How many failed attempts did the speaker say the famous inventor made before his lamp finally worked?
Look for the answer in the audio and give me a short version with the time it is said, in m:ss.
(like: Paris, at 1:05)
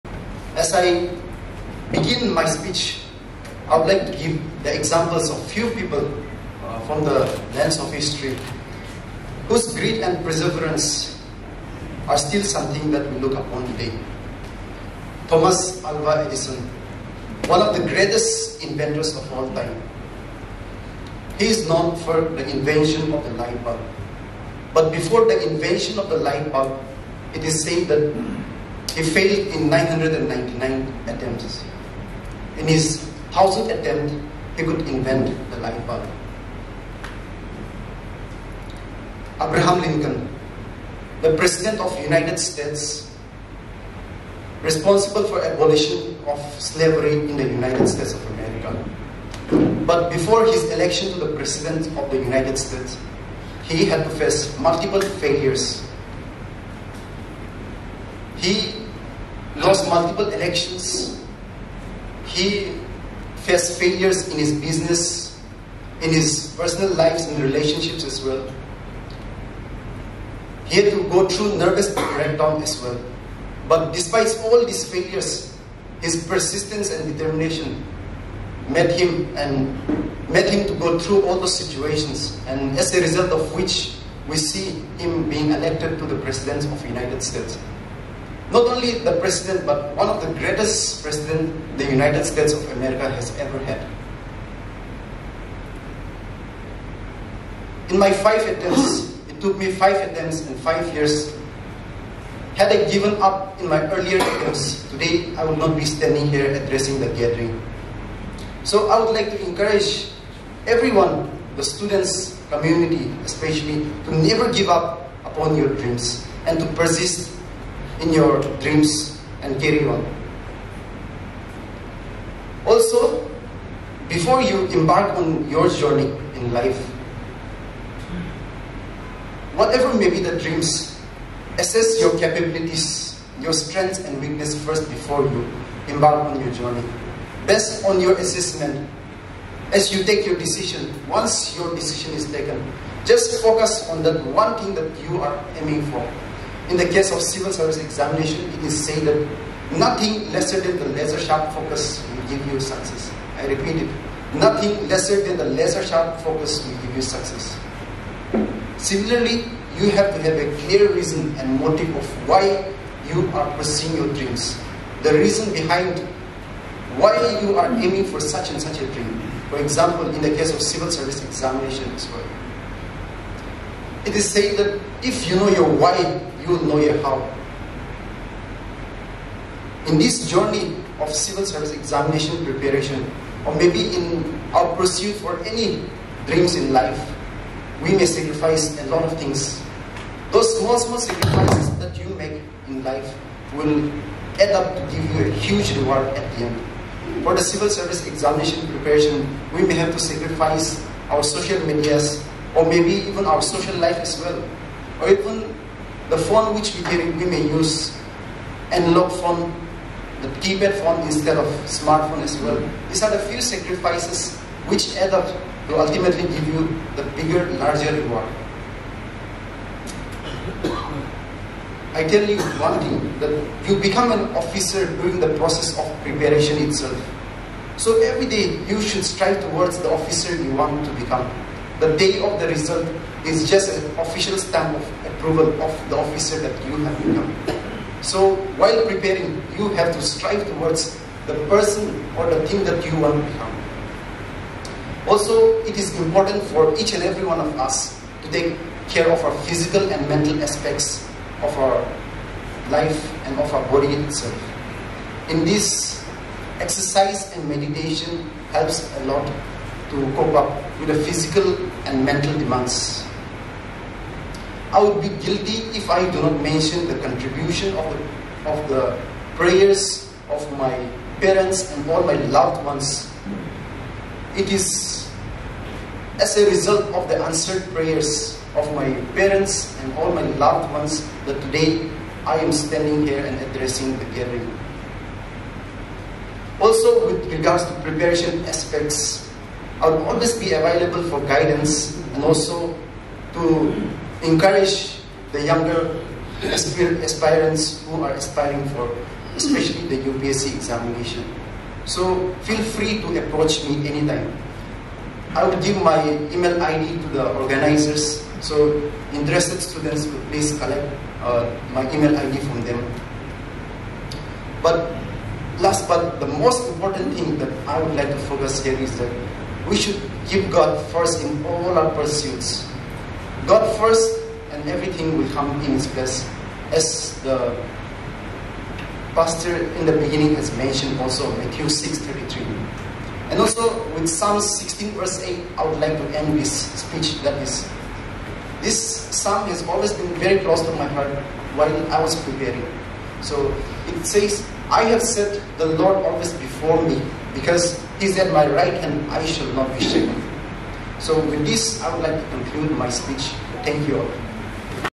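999, at 0:29.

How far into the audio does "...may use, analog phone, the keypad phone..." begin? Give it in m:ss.
3:27.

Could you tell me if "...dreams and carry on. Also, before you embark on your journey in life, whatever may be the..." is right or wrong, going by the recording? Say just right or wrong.
right.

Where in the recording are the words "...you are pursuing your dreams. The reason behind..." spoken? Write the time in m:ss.
2:43.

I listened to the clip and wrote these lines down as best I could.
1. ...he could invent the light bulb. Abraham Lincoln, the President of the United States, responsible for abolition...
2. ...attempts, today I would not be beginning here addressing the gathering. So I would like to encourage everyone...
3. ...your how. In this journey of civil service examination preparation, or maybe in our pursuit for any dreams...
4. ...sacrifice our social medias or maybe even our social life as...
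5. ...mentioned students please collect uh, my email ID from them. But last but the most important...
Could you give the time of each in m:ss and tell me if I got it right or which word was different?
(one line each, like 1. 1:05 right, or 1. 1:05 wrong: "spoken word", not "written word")
1. 0:34 right
2. 1:44 wrong: "standing", not "beginning"
3. 2:56 right
4. 3:19 right
5. 5:09 wrong: "interested", not "mentioned".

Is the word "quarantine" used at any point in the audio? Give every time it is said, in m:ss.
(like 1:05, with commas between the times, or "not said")
not said.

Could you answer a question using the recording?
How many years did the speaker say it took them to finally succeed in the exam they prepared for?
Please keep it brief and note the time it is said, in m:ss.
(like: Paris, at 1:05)
5, at 1:40.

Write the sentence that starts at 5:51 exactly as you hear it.
So with this, I would like to conclude my speech.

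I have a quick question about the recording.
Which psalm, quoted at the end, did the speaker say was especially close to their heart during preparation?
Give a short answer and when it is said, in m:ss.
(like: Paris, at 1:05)
Psalm 16:8, at 5:34.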